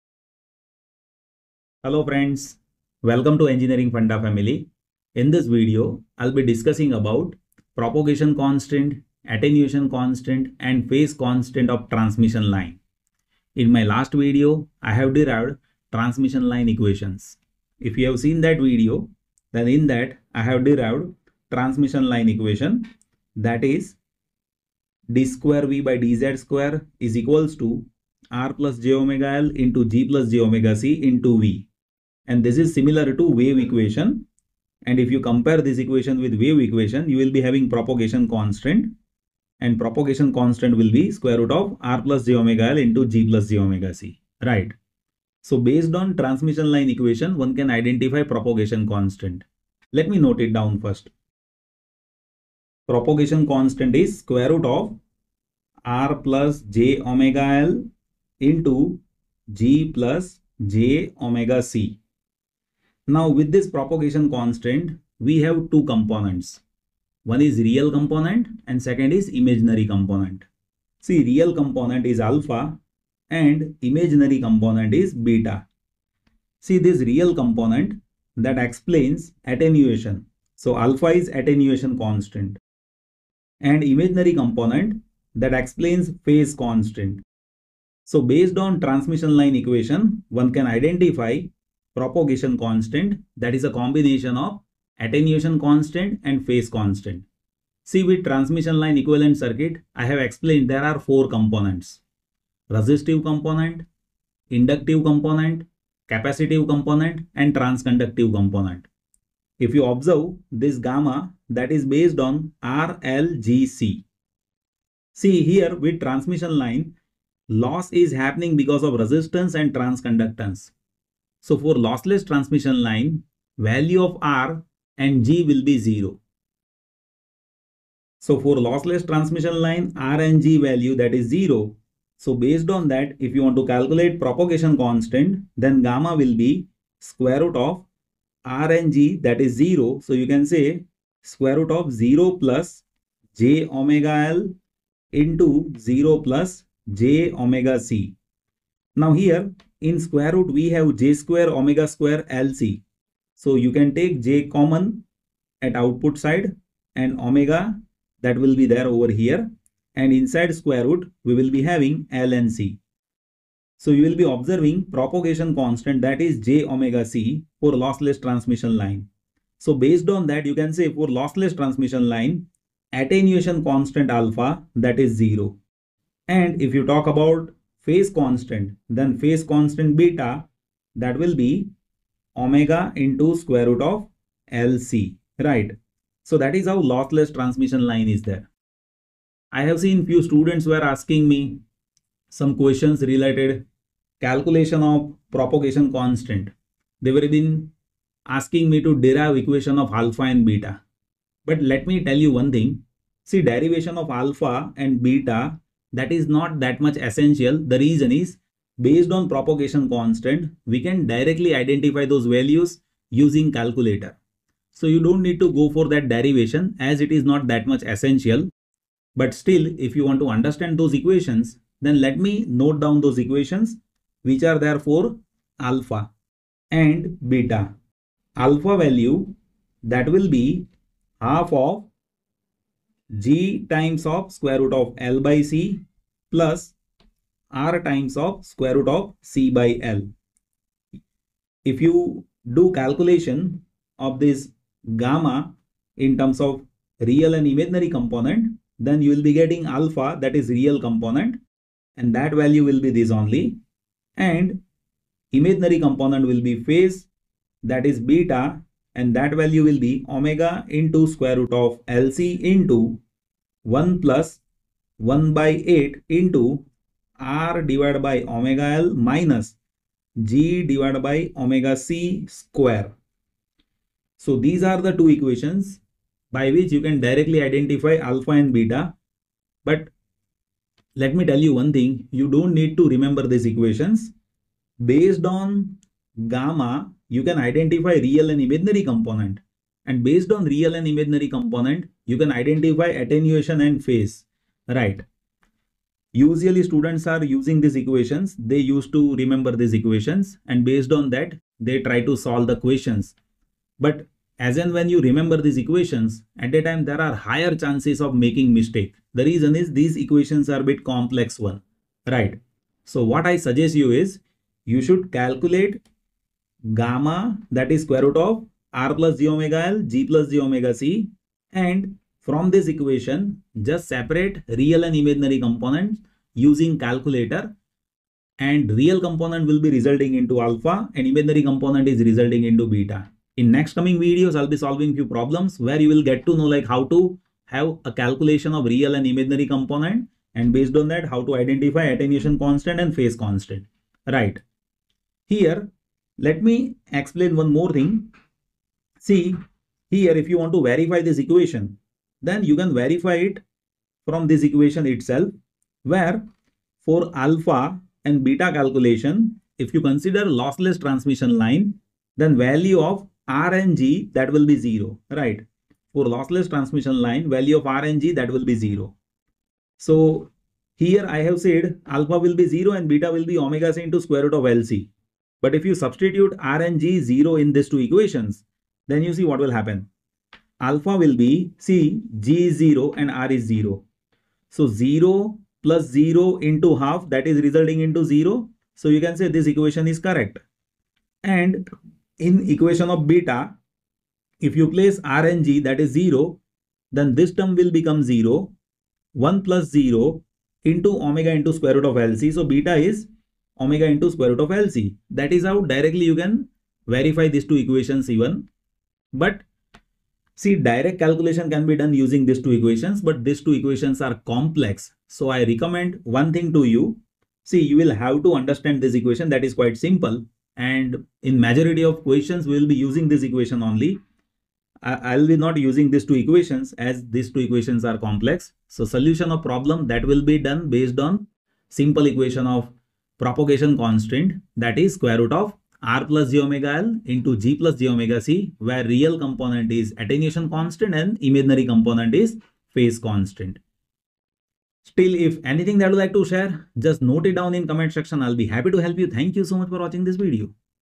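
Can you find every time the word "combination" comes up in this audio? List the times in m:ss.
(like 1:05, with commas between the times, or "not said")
1:33.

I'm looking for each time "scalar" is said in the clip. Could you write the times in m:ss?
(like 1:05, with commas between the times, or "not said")
not said.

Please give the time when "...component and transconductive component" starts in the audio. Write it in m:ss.
1:46.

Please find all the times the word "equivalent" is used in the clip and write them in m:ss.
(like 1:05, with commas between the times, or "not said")
1:38.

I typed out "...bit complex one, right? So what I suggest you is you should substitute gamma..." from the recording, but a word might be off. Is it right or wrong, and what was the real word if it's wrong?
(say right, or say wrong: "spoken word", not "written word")
wrong: "calculate", not "substitute".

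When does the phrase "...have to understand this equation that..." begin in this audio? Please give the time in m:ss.
6:58.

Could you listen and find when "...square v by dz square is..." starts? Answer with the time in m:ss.
0:25.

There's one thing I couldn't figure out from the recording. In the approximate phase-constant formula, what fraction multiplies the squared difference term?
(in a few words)
1/8.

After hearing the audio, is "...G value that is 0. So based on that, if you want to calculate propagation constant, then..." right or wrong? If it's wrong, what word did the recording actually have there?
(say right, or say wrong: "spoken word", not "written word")
right.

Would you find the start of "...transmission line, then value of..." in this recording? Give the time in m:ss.
6:00.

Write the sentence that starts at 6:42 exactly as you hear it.
So beta is omega into square root of LC.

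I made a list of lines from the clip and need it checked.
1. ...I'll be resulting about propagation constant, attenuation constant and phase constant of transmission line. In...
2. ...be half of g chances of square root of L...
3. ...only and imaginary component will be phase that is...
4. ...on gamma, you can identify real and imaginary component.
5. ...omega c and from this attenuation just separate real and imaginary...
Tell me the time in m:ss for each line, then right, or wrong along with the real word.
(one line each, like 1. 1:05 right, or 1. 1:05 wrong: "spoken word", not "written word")
1. 0:06 wrong: "discussing", not "resulting"
2. 3:50 wrong: "times", not "chances"
3. 4:13 right
4. 4:45 right
5. 5:20 wrong: "equation", not "attenuation".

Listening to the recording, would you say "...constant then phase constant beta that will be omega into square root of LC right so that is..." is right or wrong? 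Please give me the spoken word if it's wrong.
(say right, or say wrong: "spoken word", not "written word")
right.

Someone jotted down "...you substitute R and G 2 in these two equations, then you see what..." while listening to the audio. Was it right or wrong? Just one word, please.
wrong.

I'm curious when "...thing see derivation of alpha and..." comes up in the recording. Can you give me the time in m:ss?
3:22.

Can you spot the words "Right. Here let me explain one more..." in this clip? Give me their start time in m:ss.
5:44.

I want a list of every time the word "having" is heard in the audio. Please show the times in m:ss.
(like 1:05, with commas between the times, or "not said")
0:37, 2:41.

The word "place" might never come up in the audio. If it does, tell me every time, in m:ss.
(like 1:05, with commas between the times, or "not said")
6:34.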